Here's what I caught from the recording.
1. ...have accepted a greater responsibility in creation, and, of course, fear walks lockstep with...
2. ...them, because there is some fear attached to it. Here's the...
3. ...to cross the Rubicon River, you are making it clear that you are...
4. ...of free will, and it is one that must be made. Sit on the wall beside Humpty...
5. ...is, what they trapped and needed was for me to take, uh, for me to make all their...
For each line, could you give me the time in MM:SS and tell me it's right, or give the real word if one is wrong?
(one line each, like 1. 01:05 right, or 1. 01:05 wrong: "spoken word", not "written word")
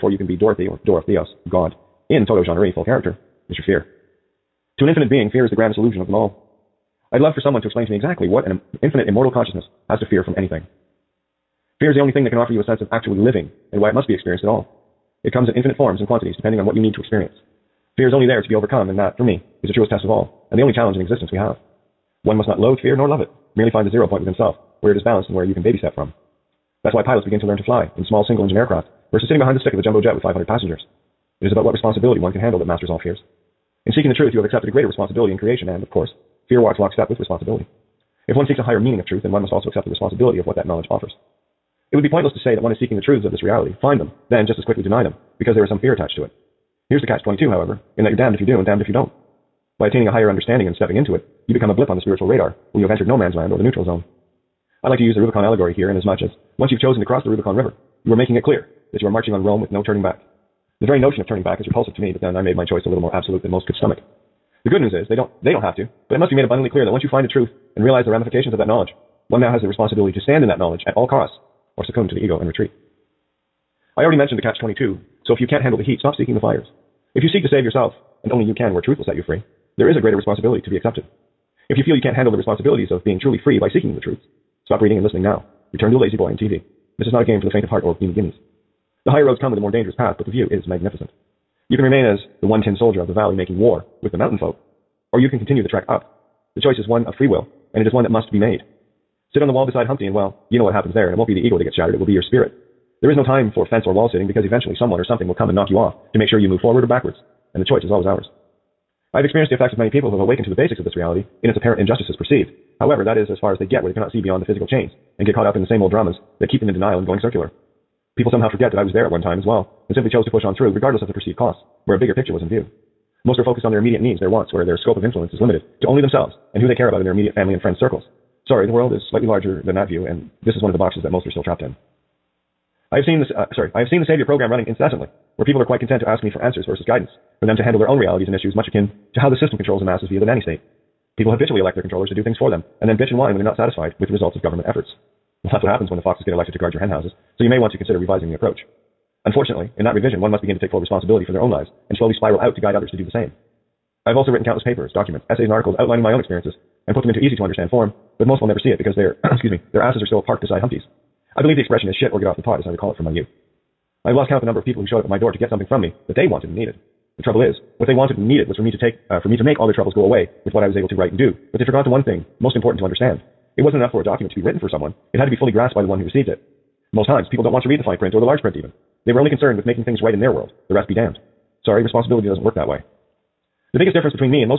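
1. 00:34 right
2. 00:45 right
3. 00:57 right
4. 01:37 right
5. 02:47 wrong: "wanted", not "trapped".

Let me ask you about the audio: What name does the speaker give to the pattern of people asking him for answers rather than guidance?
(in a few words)
Savior program.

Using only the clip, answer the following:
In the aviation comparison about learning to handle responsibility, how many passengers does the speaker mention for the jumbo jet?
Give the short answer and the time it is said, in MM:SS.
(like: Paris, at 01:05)
500, at 00:30.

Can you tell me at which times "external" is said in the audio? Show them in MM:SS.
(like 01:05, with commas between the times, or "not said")
not said.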